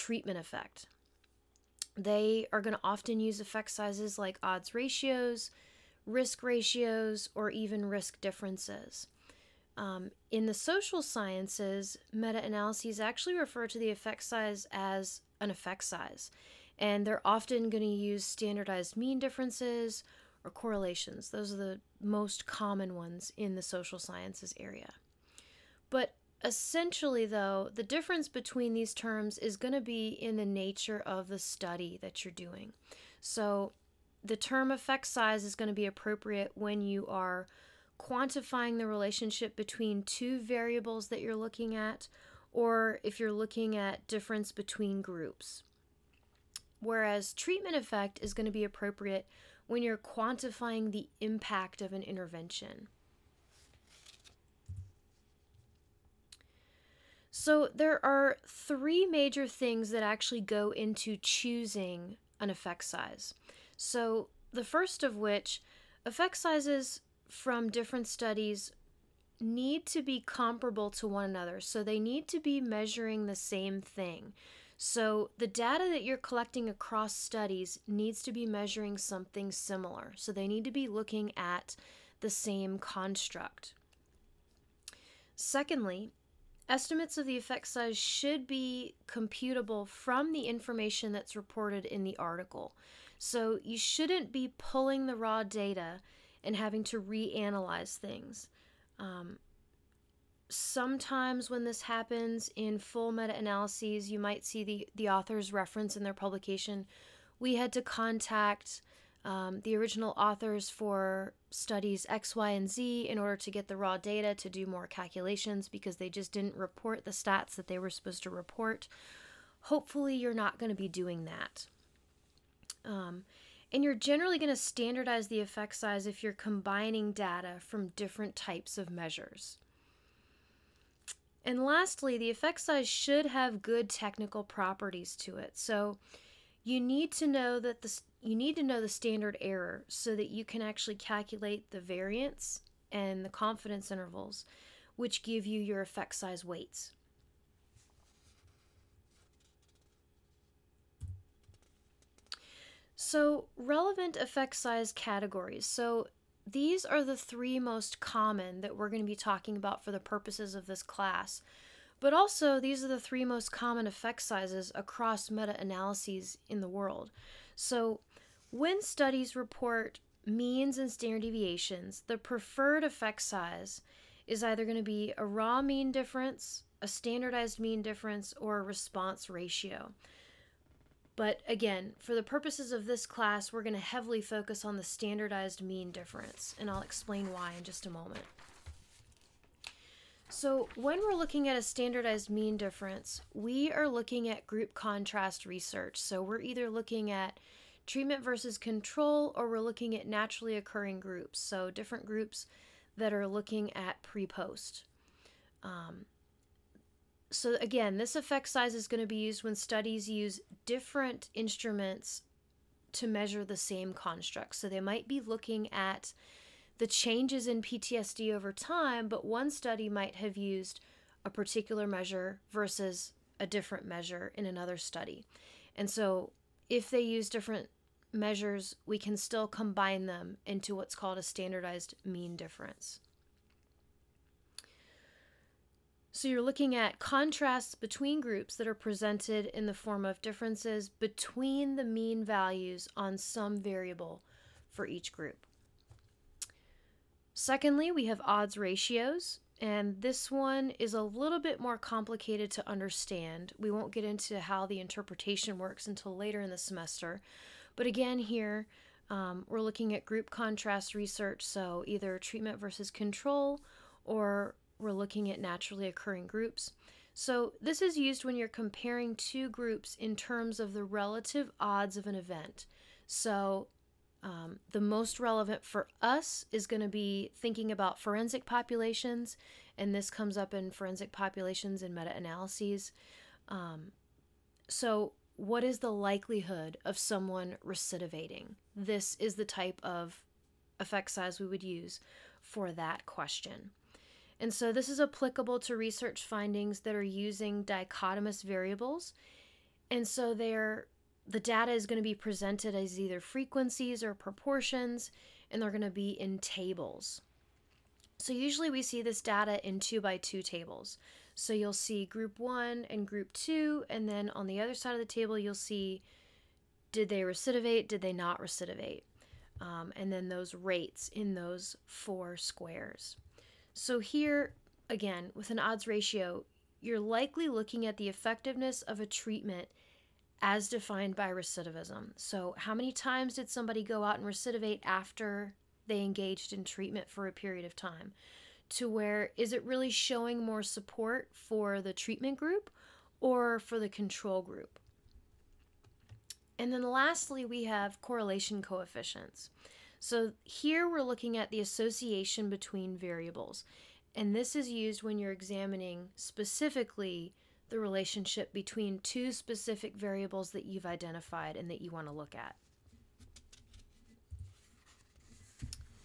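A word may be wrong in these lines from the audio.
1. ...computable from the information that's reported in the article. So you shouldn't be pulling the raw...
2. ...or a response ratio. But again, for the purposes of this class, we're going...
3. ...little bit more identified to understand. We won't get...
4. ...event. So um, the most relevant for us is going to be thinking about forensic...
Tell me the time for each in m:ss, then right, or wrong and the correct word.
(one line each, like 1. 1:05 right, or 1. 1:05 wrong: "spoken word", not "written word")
1. 1:29 right
2. 2:58 right
3. 4:11 wrong: "complicated", not "identified"
4. 4:32 right.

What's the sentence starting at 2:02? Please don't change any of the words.
Um, and you're generally going to standardize the effect size if you're combining data from different types of measures.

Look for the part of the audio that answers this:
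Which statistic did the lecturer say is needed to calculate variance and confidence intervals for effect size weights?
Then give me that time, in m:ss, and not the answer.
2:18.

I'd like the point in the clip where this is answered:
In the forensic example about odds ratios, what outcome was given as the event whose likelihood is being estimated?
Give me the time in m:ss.
4:47.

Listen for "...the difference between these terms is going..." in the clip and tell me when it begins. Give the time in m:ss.
0:27.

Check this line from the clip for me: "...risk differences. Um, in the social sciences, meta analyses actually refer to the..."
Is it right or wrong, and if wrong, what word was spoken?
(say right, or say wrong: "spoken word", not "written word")
right.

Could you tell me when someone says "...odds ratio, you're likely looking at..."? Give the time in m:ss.
5:25.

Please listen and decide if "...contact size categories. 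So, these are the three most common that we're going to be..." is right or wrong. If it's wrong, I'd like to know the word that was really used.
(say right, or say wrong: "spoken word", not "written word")
wrong: "effect", not "contact".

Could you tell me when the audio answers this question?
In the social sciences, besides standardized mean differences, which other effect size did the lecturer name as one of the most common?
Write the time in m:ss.
0:20.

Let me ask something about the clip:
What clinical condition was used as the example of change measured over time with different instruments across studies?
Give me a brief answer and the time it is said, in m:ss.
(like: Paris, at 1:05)
PTSD, at 3:37.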